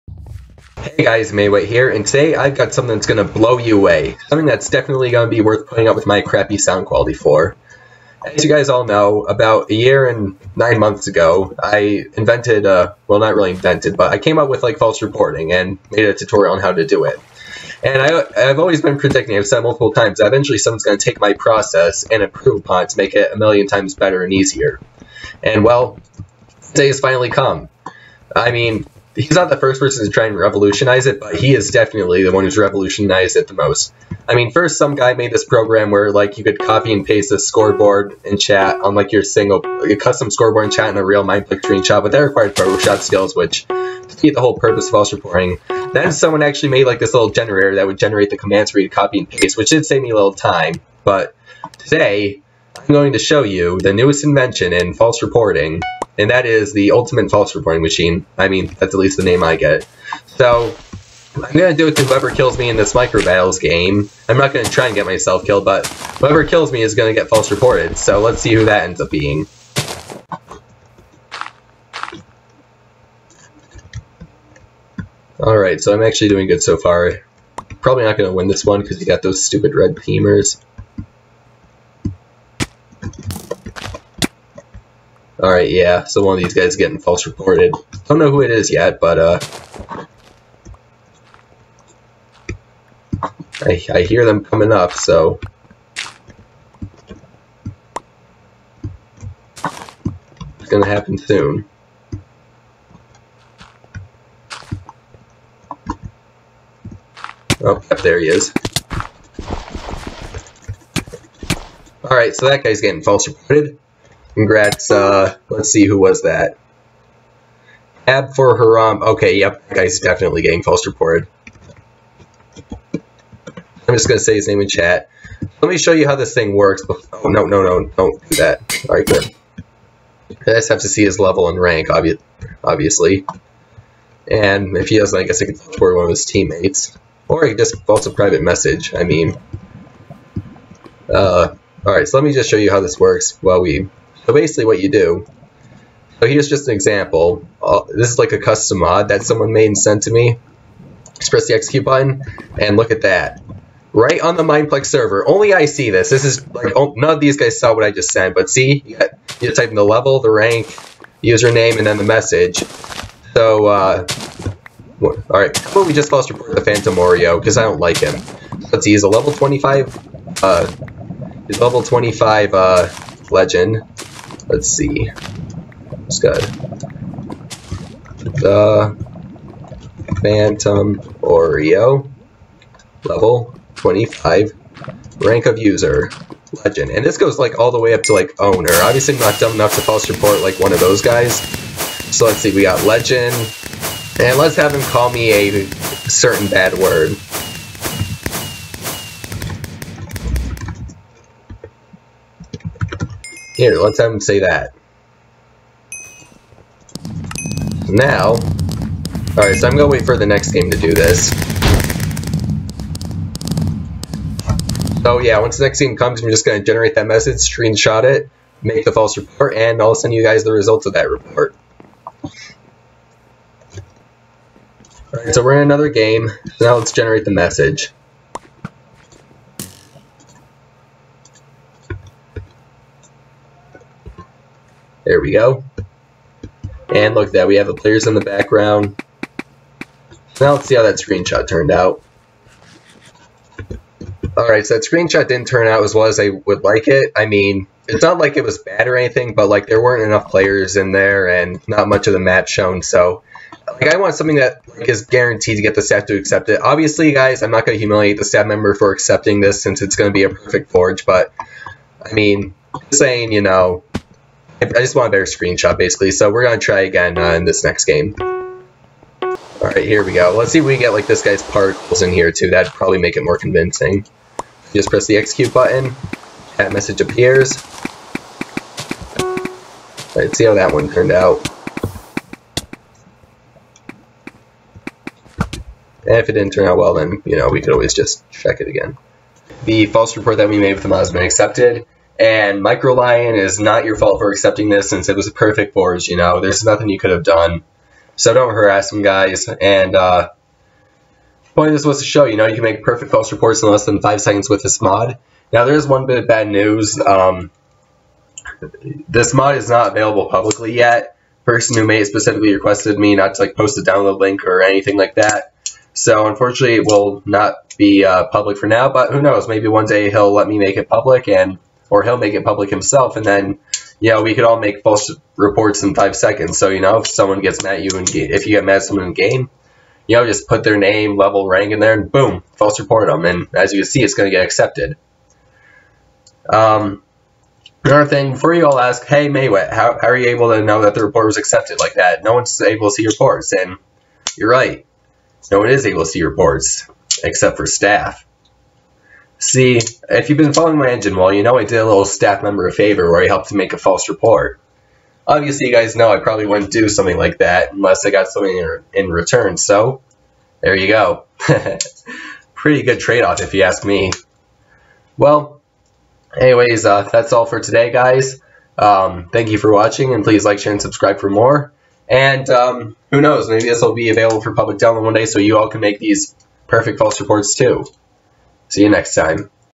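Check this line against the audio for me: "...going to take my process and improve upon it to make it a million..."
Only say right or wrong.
right.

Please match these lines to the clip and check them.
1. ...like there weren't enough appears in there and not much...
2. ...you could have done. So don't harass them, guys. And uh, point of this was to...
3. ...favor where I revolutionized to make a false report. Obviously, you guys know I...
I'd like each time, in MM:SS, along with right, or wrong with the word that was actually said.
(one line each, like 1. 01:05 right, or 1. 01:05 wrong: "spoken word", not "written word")
1. 04:09 wrong: "players", not "appears"
2. 04:56 right
3. 05:52 wrong: "helped", not "revolutionized".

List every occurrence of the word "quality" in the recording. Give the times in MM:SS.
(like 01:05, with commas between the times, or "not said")
00:06.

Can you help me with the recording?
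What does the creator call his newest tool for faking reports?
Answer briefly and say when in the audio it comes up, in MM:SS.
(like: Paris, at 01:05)
Ultimate False Reporting Machine, at 00:56.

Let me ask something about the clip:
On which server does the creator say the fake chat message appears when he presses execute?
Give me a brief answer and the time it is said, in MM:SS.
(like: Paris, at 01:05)
Mineplex, at 02:34.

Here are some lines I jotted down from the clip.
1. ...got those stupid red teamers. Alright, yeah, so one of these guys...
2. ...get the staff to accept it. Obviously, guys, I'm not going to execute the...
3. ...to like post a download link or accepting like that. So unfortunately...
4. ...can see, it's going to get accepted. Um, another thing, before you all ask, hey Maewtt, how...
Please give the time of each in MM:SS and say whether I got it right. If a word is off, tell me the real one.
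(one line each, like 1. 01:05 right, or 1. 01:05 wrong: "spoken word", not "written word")
1. 01:19 right
2. 04:15 wrong: "humiliate", not "execute"
3. 05:13 wrong: "anything", not "accepting"
4. 05:33 right.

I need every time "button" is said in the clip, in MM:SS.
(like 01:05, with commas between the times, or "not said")
02:31, 04:35.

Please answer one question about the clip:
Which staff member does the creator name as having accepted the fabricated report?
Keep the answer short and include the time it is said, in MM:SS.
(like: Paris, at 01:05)
Micro Lion, at 04:52.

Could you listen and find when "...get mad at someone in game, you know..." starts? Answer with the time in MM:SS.
05:28.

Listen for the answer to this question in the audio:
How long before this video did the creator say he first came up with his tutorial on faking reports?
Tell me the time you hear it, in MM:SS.
00:09.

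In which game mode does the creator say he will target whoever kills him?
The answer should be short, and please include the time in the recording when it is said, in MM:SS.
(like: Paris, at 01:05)
Micro Battles, at 01:02.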